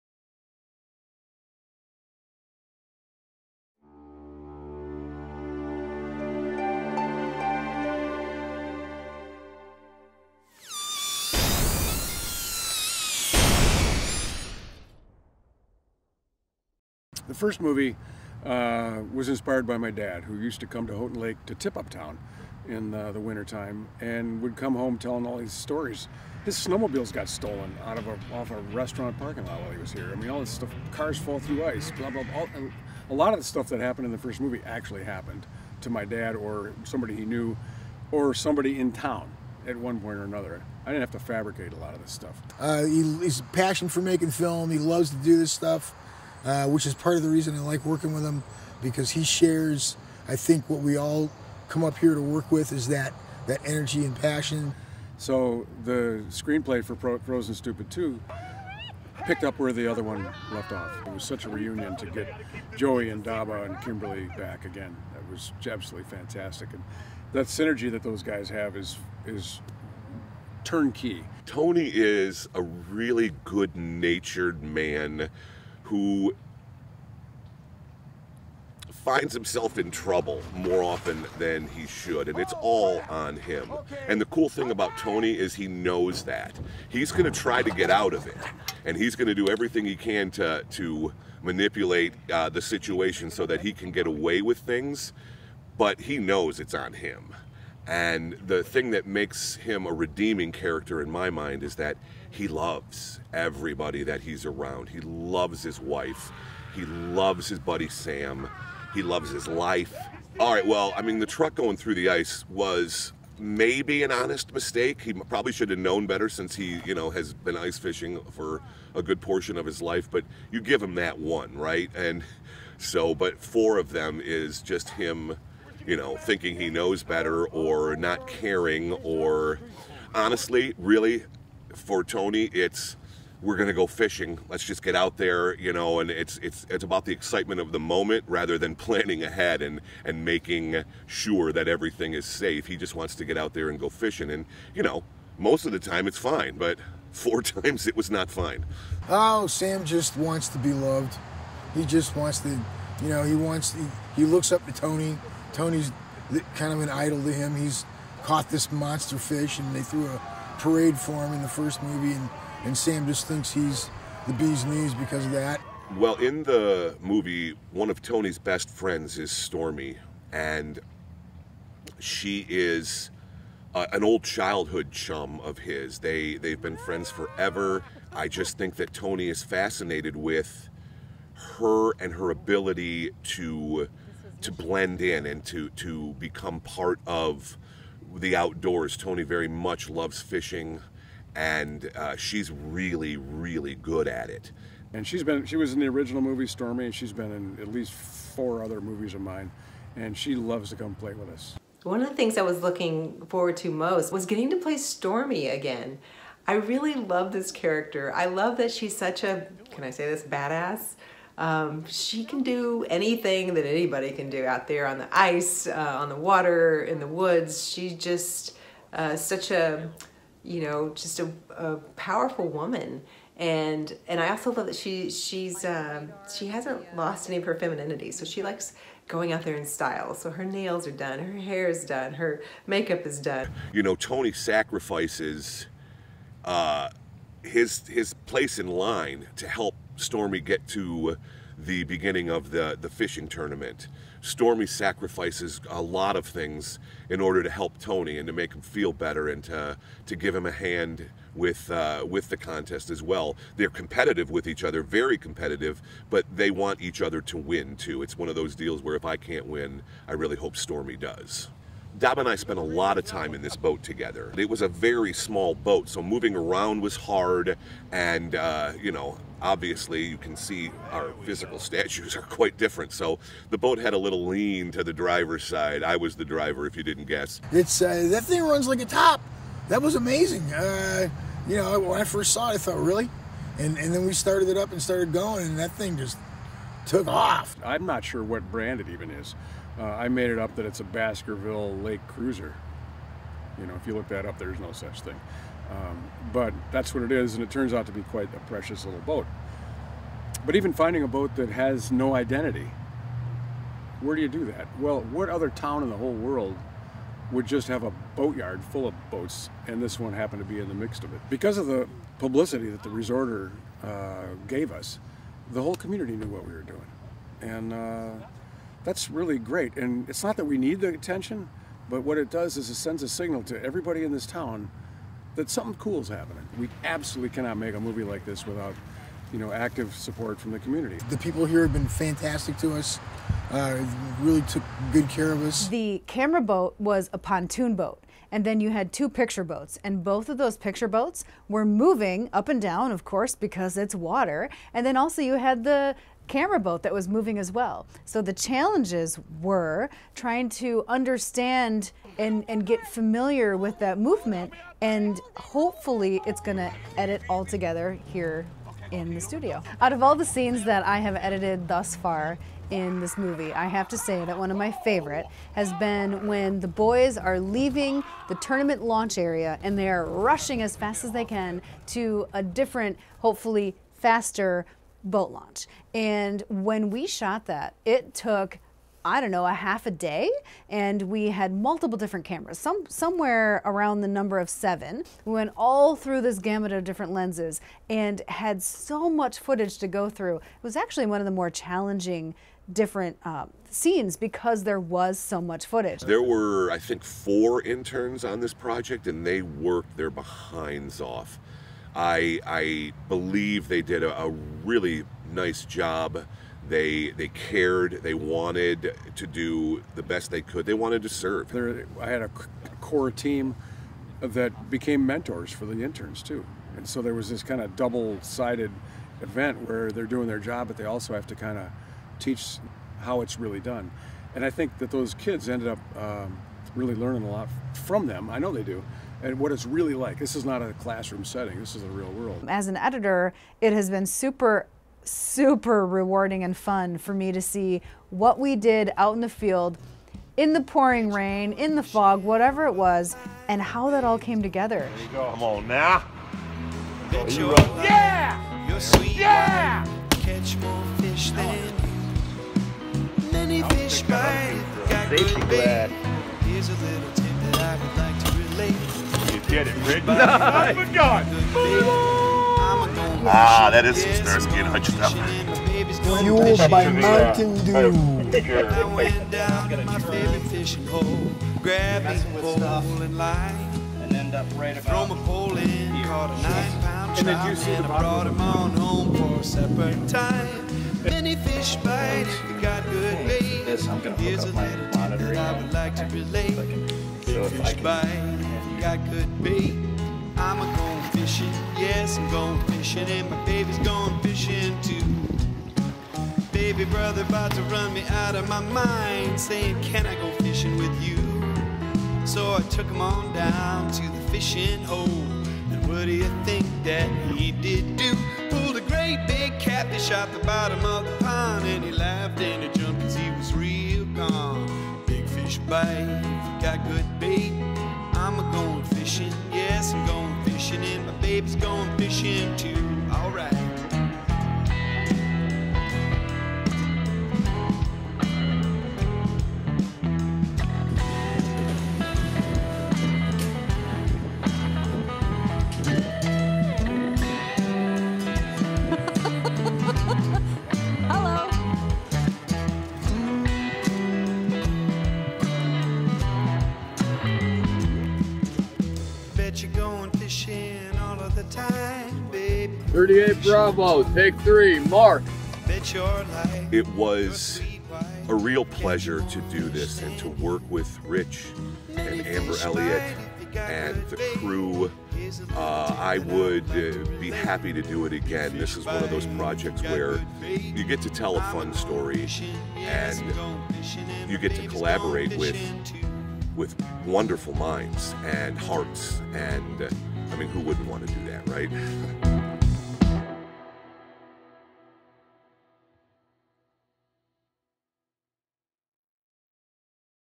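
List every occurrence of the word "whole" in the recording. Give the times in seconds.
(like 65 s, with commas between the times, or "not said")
305 s, 315 s.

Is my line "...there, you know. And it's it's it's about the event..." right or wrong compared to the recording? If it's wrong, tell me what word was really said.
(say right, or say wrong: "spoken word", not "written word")
wrong: "excitement", not "event".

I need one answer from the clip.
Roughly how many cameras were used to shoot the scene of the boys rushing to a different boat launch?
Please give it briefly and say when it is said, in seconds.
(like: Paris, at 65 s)
7, at 384 s.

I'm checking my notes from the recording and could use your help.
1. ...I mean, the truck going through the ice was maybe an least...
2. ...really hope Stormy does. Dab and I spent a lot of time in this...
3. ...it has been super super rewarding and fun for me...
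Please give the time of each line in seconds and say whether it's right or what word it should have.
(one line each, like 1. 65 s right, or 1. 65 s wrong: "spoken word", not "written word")
1. 110 s wrong: "honest", not "least"
2. 260 s right
3. 433 s right.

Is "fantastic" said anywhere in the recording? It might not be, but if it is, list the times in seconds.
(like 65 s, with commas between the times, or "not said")
66 s, 331 s.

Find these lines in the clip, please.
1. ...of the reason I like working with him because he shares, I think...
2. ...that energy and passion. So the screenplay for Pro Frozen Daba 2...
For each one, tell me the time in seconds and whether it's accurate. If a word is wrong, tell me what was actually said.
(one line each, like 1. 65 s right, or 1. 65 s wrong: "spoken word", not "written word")
1. 47 s right
2. 53 s wrong: "Stupid", not "Daba".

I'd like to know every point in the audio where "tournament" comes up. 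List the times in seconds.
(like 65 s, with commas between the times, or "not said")
243 s, 368 s.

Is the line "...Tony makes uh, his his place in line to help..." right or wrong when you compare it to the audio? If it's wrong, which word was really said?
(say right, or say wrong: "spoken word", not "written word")
wrong: "sacrifices", not "makes".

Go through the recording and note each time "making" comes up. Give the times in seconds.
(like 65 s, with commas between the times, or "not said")
44 s, 140 s.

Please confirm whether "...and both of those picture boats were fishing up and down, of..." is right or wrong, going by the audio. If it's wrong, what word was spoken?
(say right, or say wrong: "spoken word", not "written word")
wrong: "moving", not "fishing".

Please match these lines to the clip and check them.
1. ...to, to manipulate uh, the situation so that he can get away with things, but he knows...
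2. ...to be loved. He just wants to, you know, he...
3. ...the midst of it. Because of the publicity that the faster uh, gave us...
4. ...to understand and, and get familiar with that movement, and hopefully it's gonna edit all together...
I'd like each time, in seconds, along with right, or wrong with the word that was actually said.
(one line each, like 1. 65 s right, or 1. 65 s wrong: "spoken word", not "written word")
1. 90 s right
2. 150 s right
3. 310 s wrong: "resorter", not "faster"
4. 350 s right.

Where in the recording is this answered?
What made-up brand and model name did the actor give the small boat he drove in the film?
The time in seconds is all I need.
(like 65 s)
290 s.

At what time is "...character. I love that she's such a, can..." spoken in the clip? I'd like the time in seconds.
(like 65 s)
207 s.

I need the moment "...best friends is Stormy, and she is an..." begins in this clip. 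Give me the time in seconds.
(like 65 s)
168 s.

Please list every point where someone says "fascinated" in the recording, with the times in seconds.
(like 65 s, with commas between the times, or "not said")
179 s.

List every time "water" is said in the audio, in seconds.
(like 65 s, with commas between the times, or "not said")
216 s, 343 s.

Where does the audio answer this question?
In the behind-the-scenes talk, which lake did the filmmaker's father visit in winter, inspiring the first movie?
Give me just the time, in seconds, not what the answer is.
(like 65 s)
20 s.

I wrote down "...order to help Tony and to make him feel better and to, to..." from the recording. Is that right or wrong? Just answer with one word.
right.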